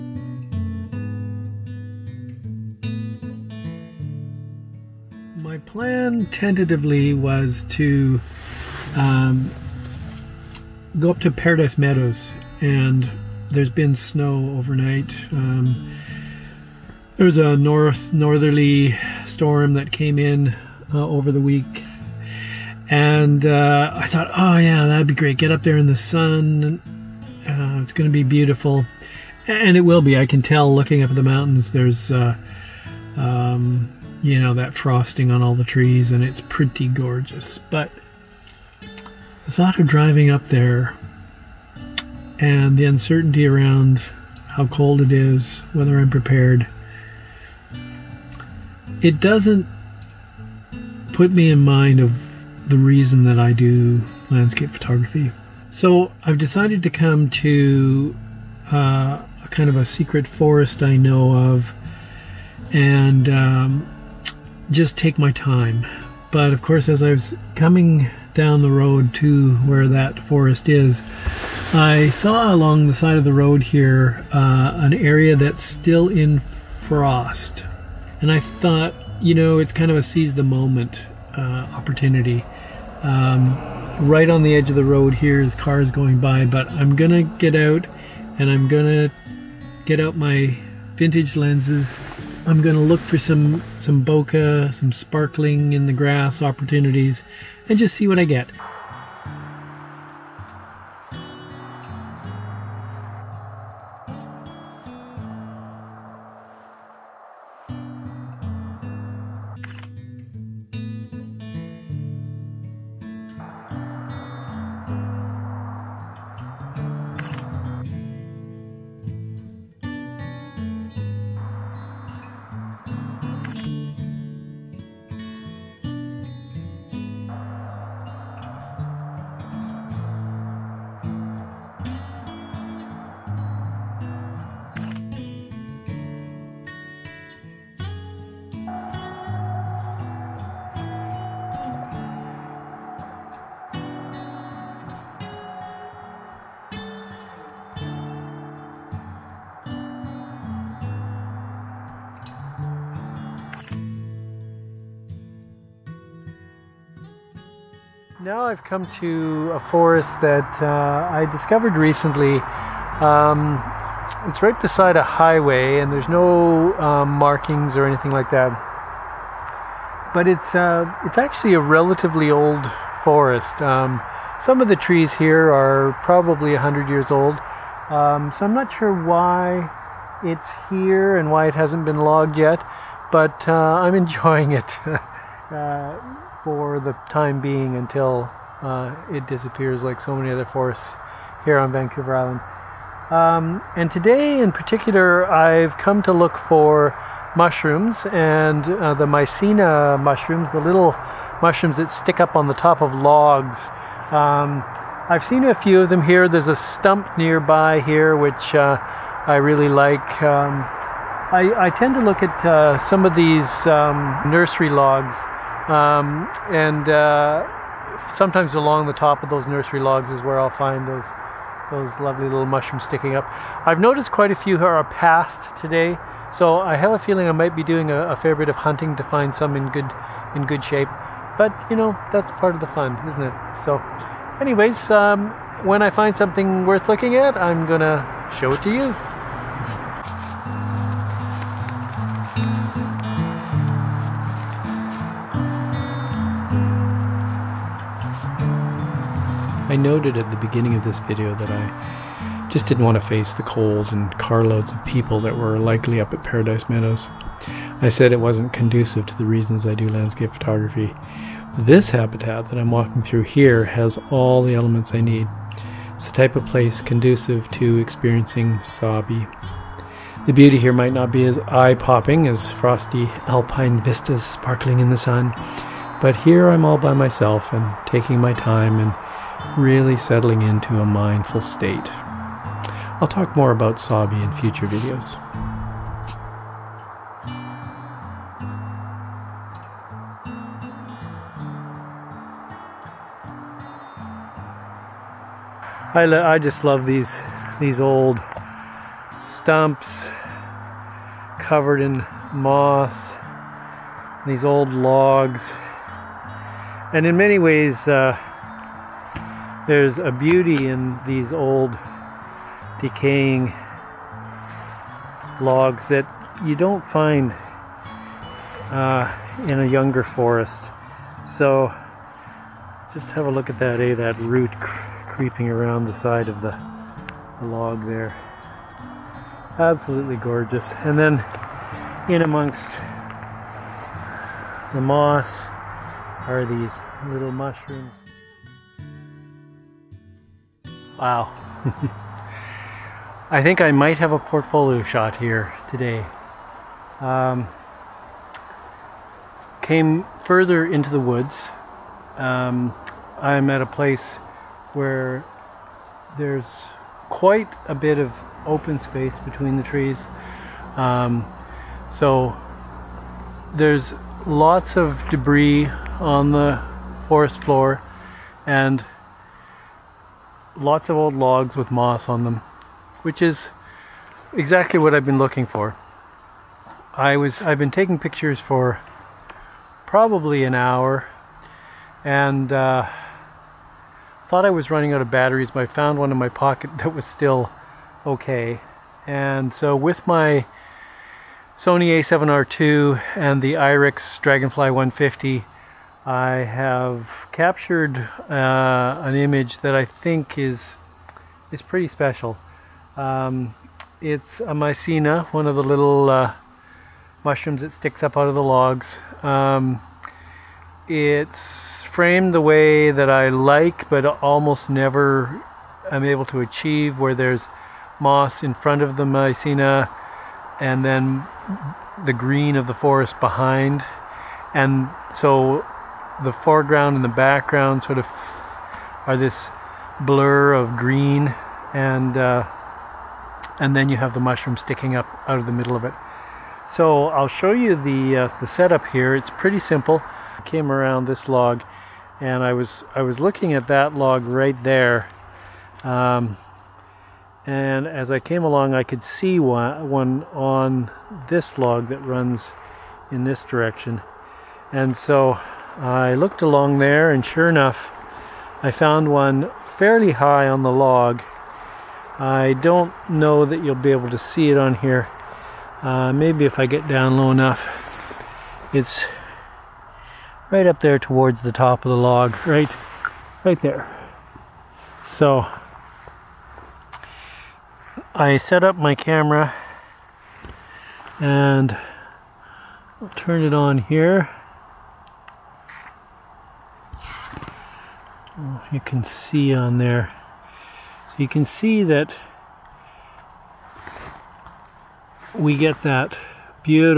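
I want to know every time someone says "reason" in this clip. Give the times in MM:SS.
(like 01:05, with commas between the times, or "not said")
00:52, 04:19.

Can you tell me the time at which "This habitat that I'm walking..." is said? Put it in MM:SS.
04:21.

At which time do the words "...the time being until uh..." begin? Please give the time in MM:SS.
03:06.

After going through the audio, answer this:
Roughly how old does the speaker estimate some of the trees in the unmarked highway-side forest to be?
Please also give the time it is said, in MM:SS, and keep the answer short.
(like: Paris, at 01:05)
100 years, at 02:56.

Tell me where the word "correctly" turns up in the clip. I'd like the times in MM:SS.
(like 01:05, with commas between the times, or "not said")
not said.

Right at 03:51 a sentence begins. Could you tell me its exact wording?
But you know that's part of the fun, isn't it?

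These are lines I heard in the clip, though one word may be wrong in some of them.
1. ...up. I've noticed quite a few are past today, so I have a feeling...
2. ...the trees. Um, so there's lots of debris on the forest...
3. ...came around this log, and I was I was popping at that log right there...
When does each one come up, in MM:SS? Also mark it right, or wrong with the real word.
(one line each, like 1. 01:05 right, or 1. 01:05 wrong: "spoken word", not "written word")
1. 03:43 right
2. 05:59 right
3. 07:20 wrong: "looking", not "popping".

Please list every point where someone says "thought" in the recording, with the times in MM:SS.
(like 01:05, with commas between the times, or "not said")
00:24, 00:39, 01:18, 06:24.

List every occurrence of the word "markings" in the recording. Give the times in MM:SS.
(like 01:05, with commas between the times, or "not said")
02:47.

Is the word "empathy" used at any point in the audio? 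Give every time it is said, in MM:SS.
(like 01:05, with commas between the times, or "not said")
not said.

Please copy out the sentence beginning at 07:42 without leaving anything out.
I don't know that you'll be able to see it on here.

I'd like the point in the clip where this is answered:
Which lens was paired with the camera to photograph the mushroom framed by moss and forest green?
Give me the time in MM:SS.
06:33.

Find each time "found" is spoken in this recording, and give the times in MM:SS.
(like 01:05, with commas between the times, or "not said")
06:25, 07:38.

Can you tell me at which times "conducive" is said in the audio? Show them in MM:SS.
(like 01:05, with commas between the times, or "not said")
04:18, 04:26.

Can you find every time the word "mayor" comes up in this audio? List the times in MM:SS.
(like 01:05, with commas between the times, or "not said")
not said.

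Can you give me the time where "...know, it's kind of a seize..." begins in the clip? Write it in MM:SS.
01:19.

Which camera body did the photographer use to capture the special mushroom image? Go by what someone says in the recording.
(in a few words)
Sony A7R II.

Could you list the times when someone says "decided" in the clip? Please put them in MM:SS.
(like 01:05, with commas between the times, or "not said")
00:56.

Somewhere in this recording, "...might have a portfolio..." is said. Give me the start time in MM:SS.
05:43.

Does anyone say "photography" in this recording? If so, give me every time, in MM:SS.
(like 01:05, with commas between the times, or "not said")
00:54, 04:20.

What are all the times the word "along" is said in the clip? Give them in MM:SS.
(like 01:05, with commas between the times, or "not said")
01:12, 03:38, 07:28, 07:36.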